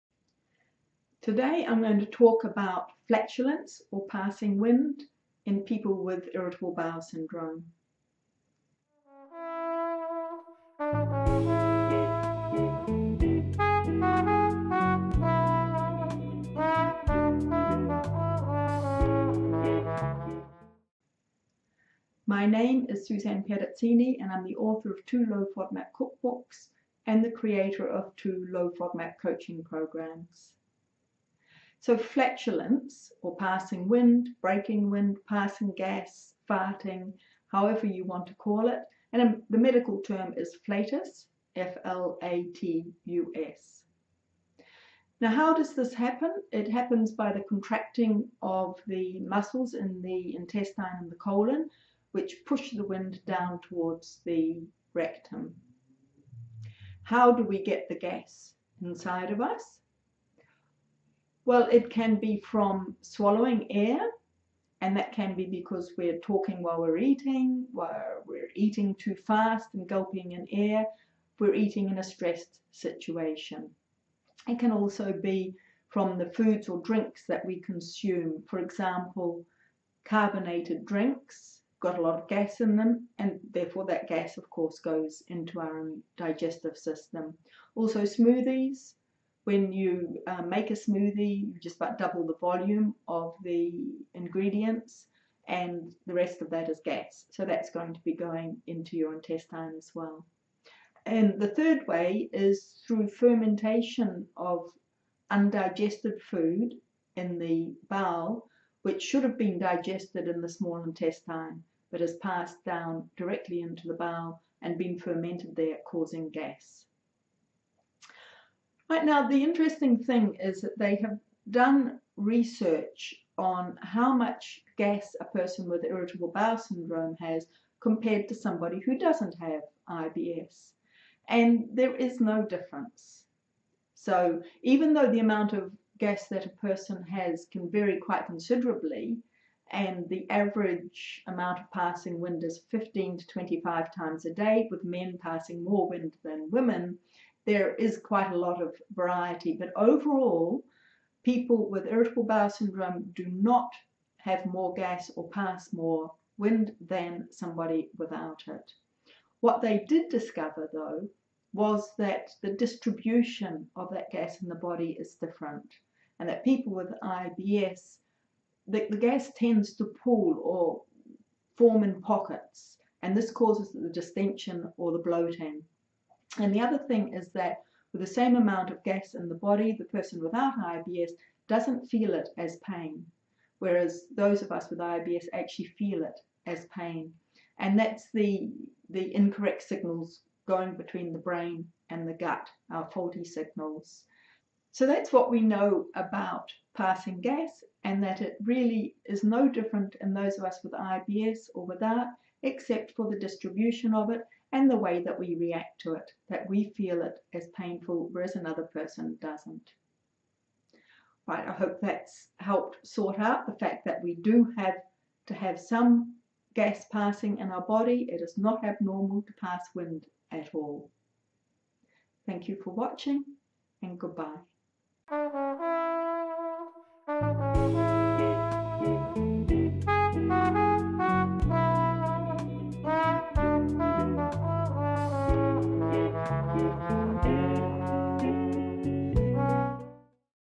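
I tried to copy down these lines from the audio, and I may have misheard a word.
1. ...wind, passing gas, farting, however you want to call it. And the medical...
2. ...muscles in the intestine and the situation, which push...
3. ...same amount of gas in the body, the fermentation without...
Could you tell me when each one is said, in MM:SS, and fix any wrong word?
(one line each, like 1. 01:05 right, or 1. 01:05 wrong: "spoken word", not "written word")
1. 00:34 right
2. 00:49 wrong: "colon", not "situation"
3. 02:58 wrong: "person", not "fermentation".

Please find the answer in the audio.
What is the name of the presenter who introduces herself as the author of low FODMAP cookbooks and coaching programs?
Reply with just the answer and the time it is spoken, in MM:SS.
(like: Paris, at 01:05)
Suzanne Perazzini, at 00:23.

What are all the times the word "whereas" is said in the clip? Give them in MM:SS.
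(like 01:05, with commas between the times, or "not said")
03:03, 03:28.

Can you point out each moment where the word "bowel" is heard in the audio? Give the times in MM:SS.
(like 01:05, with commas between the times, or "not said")
00:06, 01:47, 01:53, 02:06, 02:32.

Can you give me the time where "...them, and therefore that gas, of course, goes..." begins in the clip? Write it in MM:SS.
01:22.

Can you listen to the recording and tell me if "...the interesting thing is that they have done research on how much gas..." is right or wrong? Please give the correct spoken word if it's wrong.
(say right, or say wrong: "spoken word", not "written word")
right.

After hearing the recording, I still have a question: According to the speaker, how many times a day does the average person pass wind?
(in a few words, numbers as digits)
15 to 25.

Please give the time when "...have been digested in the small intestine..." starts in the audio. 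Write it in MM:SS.
01:49.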